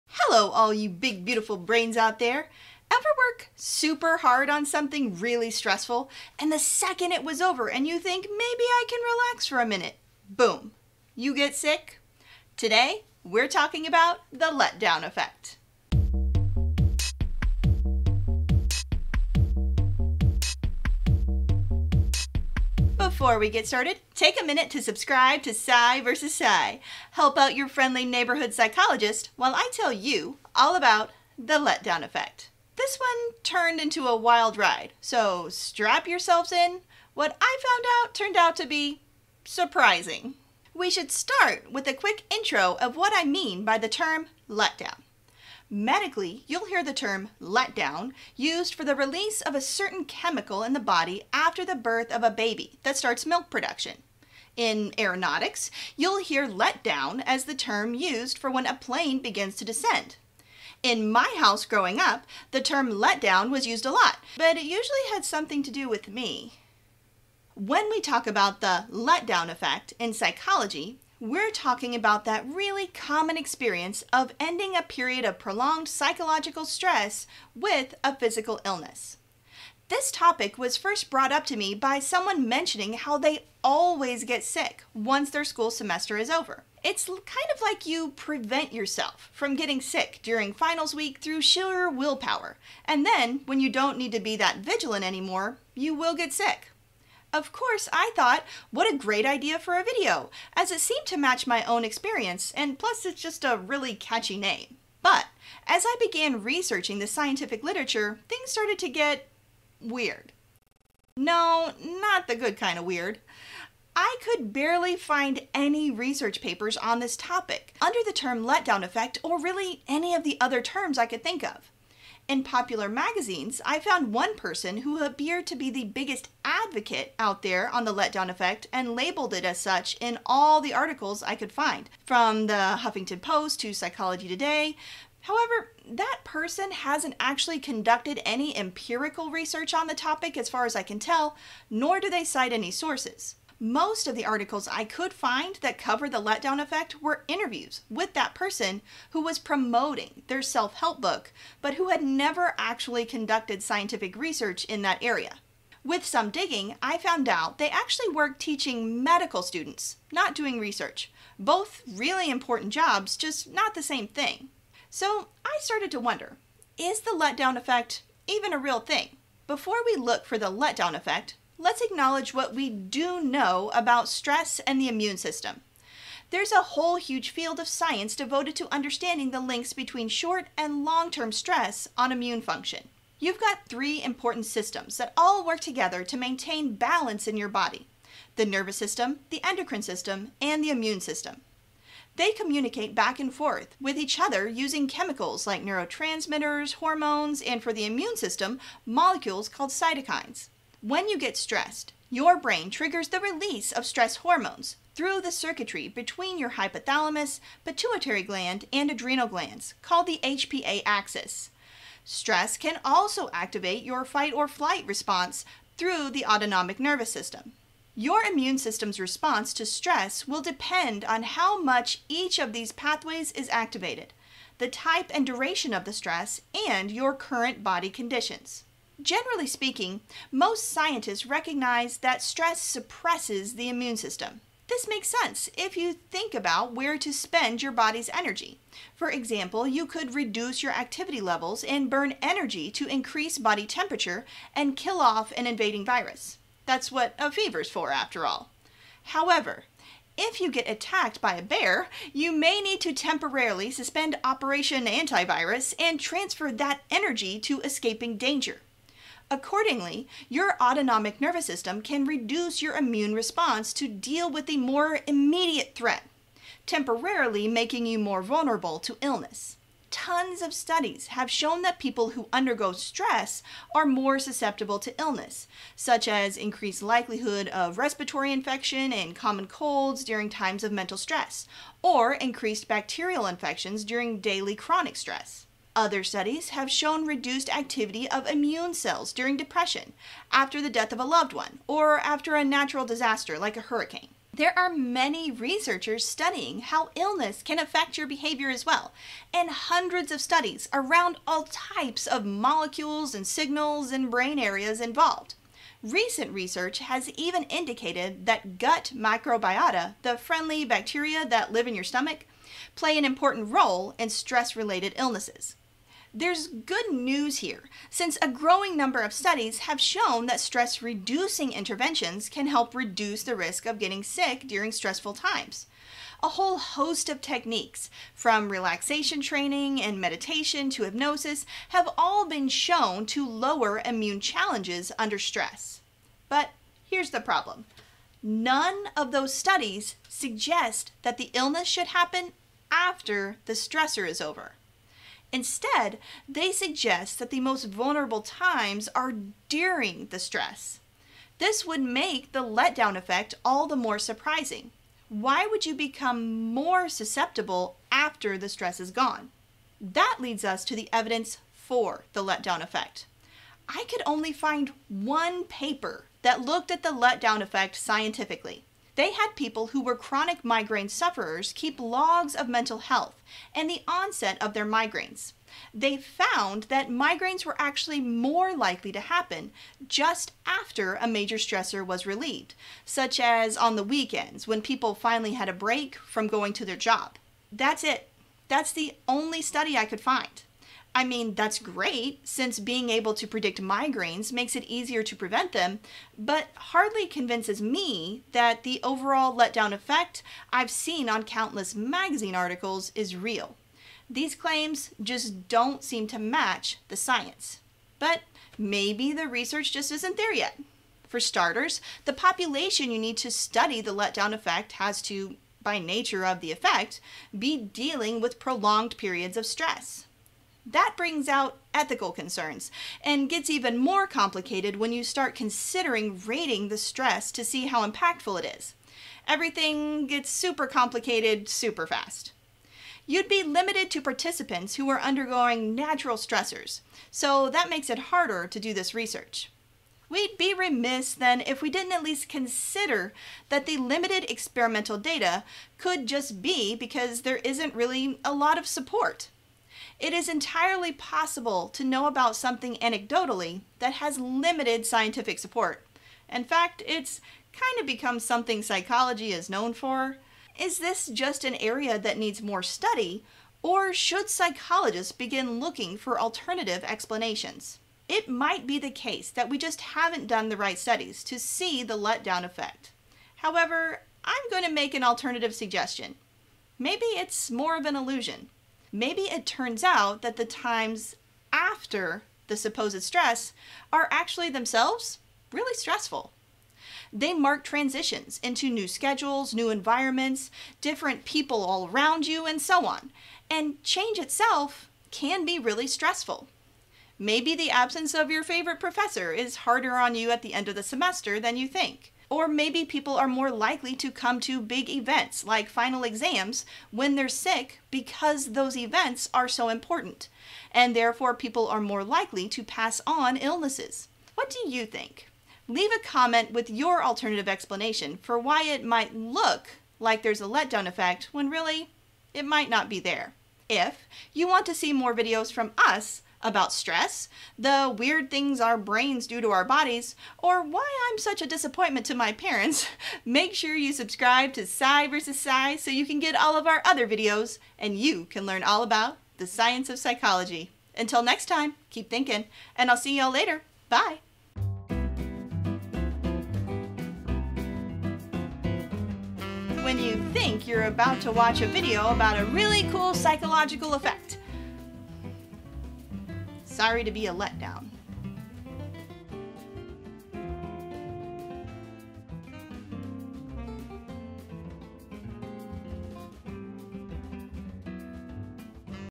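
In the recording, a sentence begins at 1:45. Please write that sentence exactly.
But, as I began researching the scientific literature, things started to get weird.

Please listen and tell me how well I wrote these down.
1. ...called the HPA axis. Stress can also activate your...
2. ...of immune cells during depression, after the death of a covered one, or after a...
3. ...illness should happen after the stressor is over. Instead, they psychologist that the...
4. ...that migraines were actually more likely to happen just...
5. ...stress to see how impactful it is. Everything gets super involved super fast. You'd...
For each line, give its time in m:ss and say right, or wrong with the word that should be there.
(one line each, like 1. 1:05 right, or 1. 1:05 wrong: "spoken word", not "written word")
1. 3:29 right
2. 4:48 wrong: "loved", not "covered"
3. 5:41 wrong: "suggest", not "psychologist"
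4. 6:16 right
5. 7:06 wrong: "complicated", not "involved".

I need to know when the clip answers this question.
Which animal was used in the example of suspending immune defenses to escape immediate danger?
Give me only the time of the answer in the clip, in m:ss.
4:11.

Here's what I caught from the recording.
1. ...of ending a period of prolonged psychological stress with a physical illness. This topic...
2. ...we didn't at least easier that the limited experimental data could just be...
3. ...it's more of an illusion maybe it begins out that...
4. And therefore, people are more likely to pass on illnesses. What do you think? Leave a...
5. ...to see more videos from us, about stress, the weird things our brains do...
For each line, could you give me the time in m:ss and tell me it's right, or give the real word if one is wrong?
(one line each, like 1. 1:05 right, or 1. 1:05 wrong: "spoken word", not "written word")
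1. 1:14 right
2. 7:21 wrong: "consider", not "easier"
3. 7:57 wrong: "turns", not "begins"
4. 8:30 right
5. 8:44 right.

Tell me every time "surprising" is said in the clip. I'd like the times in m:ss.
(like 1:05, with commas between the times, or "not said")
0:39, 5:53.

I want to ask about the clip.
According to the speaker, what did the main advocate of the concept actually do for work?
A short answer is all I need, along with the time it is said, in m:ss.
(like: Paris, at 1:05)
Teaching medical students, at 2:38.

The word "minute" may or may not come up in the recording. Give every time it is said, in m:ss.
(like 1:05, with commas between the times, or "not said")
0:09, 0:24.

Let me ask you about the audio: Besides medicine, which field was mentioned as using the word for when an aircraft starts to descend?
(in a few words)
Aeronautics.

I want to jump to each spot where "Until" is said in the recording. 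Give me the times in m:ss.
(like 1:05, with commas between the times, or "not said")
9:00.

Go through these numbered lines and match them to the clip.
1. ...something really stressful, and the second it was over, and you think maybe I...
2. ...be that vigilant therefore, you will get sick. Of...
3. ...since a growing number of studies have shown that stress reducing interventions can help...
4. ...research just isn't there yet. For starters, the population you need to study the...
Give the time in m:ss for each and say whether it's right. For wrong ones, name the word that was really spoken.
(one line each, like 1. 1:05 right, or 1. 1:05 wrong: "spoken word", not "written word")
1. 0:04 right
2. 1:34 wrong: "anymore", not "therefore"
3. 5:17 right
4. 6:49 right.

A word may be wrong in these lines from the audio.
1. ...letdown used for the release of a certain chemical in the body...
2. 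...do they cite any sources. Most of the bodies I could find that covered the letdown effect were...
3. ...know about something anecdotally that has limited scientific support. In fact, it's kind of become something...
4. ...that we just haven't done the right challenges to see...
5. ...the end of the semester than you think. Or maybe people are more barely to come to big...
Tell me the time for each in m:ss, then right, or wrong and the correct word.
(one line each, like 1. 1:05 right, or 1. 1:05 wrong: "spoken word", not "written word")
1. 0:47 right
2. 2:21 wrong: "articles", not "bodies"
3. 7:31 right
4. 7:49 wrong: "studies", not "challenges"
5. 8:20 wrong: "likely", not "barely".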